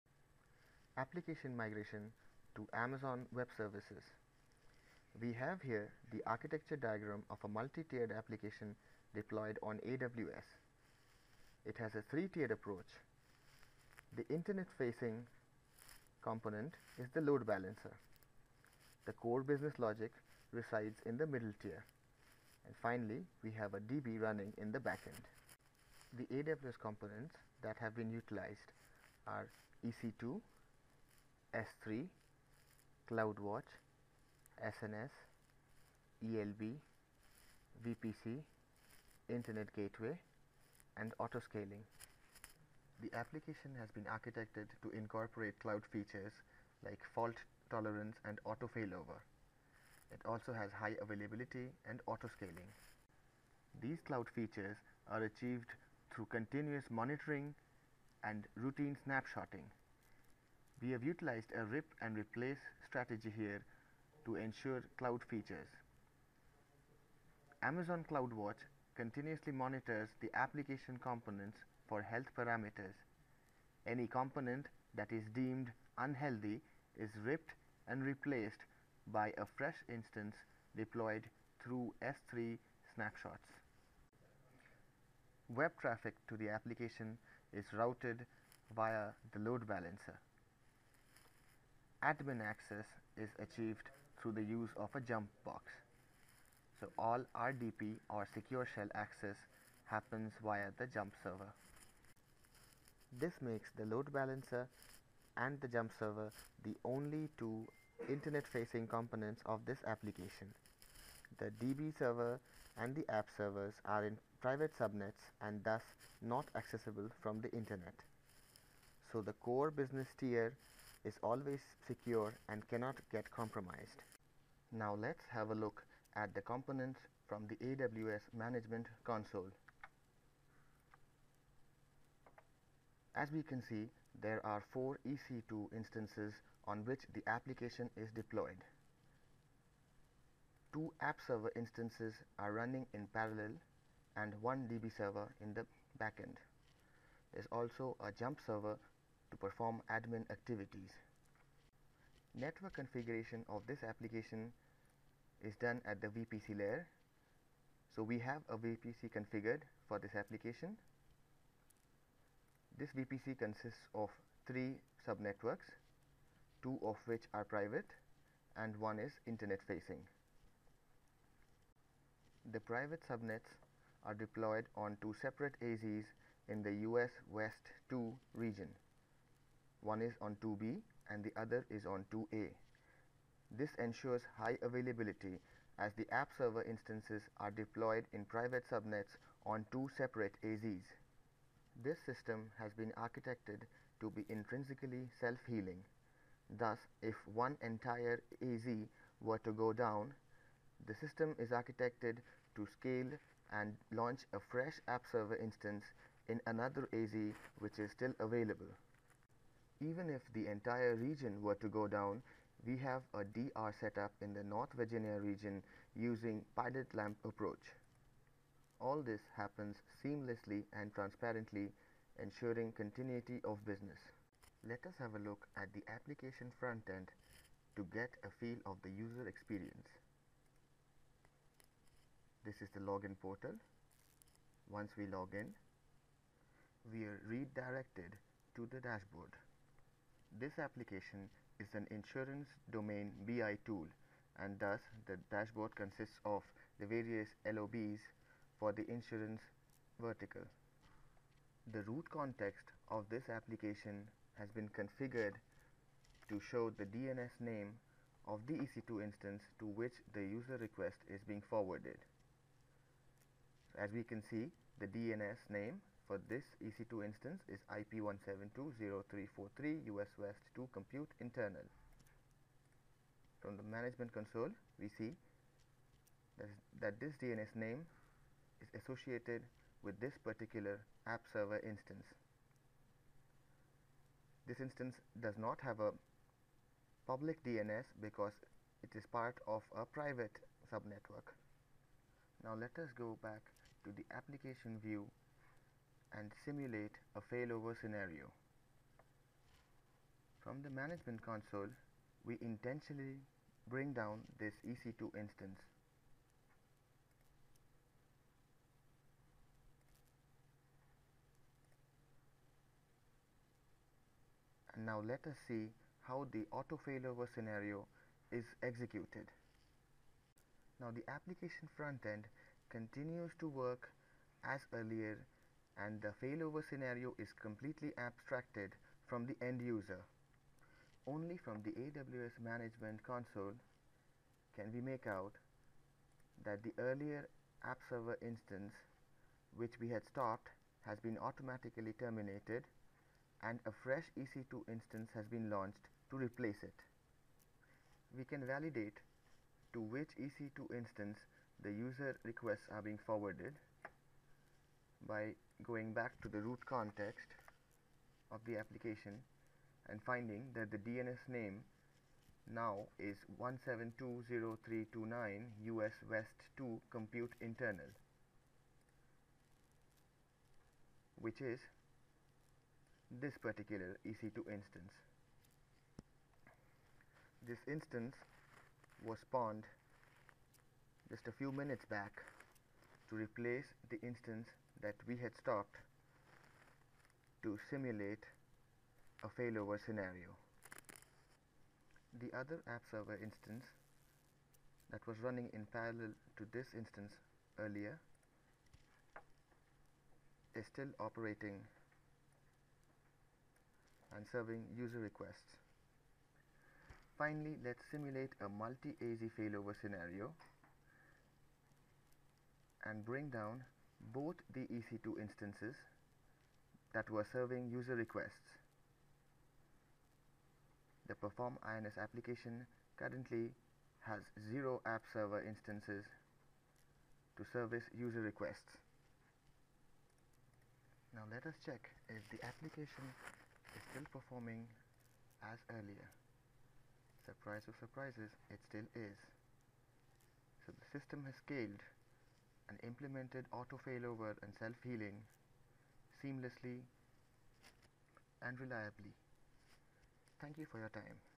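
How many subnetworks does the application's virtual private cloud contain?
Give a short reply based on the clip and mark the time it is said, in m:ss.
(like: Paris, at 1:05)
3, at 2:44.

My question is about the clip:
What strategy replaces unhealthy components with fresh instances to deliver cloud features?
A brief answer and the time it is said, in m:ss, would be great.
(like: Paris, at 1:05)
Rip and replace, at 1:01.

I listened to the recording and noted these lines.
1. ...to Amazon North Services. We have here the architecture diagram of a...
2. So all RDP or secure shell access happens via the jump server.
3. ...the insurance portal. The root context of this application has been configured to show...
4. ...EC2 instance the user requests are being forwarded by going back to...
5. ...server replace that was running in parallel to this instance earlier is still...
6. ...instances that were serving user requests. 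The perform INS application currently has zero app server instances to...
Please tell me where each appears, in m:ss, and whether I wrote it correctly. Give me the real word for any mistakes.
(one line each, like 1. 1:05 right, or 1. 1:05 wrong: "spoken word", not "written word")
1. 0:02 wrong: "Web", not "North"
2. 1:36 right
3. 4:08 wrong: "vertical", not "portal"
4. 5:50 right
5. 6:32 wrong: "instance", not "replace"
6. 6:55 right.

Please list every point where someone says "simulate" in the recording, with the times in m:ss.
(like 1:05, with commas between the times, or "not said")
4:56, 6:27, 6:47.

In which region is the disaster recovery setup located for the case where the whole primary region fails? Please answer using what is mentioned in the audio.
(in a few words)
North Virginia.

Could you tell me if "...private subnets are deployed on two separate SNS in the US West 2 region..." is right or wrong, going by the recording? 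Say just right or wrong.
wrong.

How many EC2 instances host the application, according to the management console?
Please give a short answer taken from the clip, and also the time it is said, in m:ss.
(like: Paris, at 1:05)
4, at 2:14.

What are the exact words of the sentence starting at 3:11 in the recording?
This system has been architected to be intrinsically self-healing.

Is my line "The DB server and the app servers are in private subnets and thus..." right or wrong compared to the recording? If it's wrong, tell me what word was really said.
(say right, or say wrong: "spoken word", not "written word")
right.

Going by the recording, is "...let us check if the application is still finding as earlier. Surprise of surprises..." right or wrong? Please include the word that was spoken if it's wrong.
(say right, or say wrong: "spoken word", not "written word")
wrong: "performing", not "finding".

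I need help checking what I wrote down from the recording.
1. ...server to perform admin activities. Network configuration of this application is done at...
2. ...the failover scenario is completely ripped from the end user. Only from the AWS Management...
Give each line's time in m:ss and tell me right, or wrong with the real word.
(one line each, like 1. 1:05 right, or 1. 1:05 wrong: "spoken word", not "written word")
1. 2:28 right
2. 5:26 wrong: "abstracted", not "ripped".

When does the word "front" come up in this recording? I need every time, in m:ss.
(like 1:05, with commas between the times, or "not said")
3:46, 5:21.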